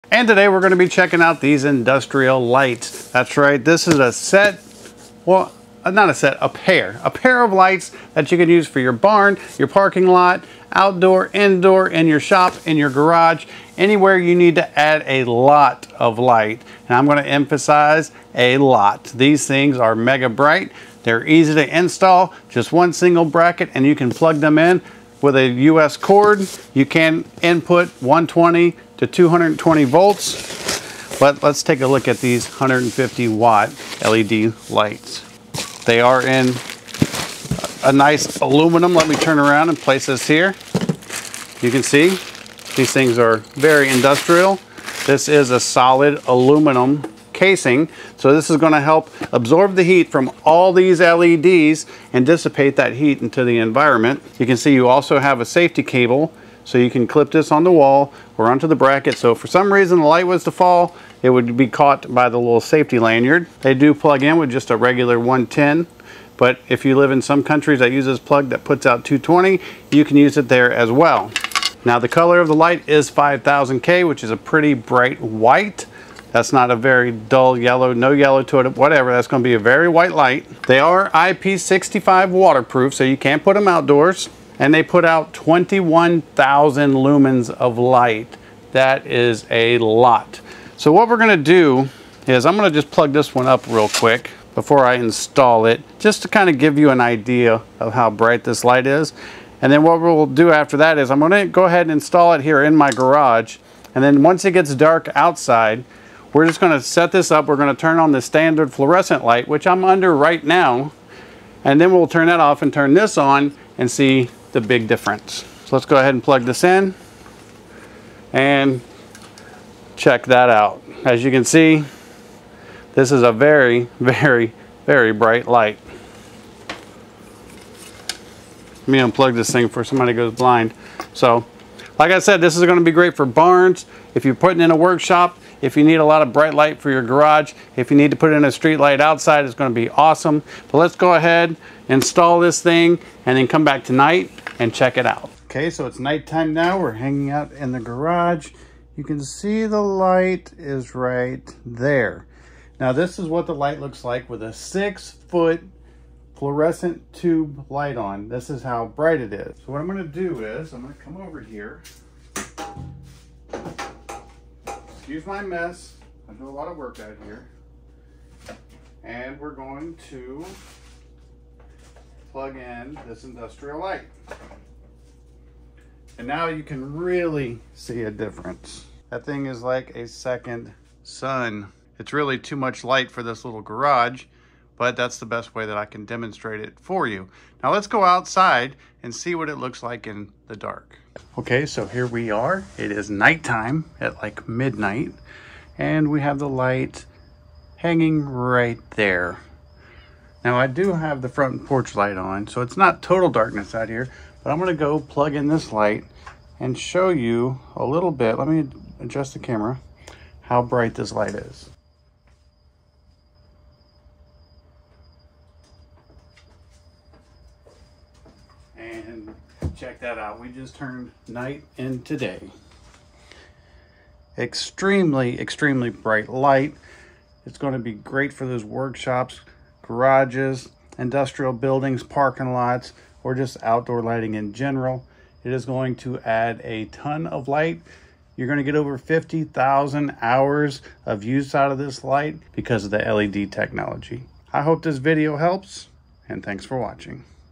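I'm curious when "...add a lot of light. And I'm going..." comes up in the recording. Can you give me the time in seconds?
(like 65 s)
14 s.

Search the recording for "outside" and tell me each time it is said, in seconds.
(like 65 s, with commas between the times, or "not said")
105 s, 138 s, 188 s.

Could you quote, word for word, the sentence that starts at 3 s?
That's right, this is a set, well, uh, not a set, a pair.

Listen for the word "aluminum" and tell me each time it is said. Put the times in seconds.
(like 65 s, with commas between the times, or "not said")
38 s, 46 s.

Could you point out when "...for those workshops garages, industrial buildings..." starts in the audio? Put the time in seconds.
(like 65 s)
228 s.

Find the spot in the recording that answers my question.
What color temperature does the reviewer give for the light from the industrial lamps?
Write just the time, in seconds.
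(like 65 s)
73 s.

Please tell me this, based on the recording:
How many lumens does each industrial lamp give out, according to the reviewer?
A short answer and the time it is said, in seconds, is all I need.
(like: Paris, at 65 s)
21,000, at 85 s.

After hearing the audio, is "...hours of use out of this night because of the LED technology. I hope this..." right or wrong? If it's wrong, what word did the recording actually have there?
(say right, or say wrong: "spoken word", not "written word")
wrong: "light", not "night".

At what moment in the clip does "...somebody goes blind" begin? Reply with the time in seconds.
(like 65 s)
129 s.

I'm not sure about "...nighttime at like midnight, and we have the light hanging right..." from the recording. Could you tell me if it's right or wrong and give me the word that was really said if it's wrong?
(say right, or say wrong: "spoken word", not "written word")
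right.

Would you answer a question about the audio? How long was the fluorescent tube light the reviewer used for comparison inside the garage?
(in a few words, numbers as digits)
6 feet.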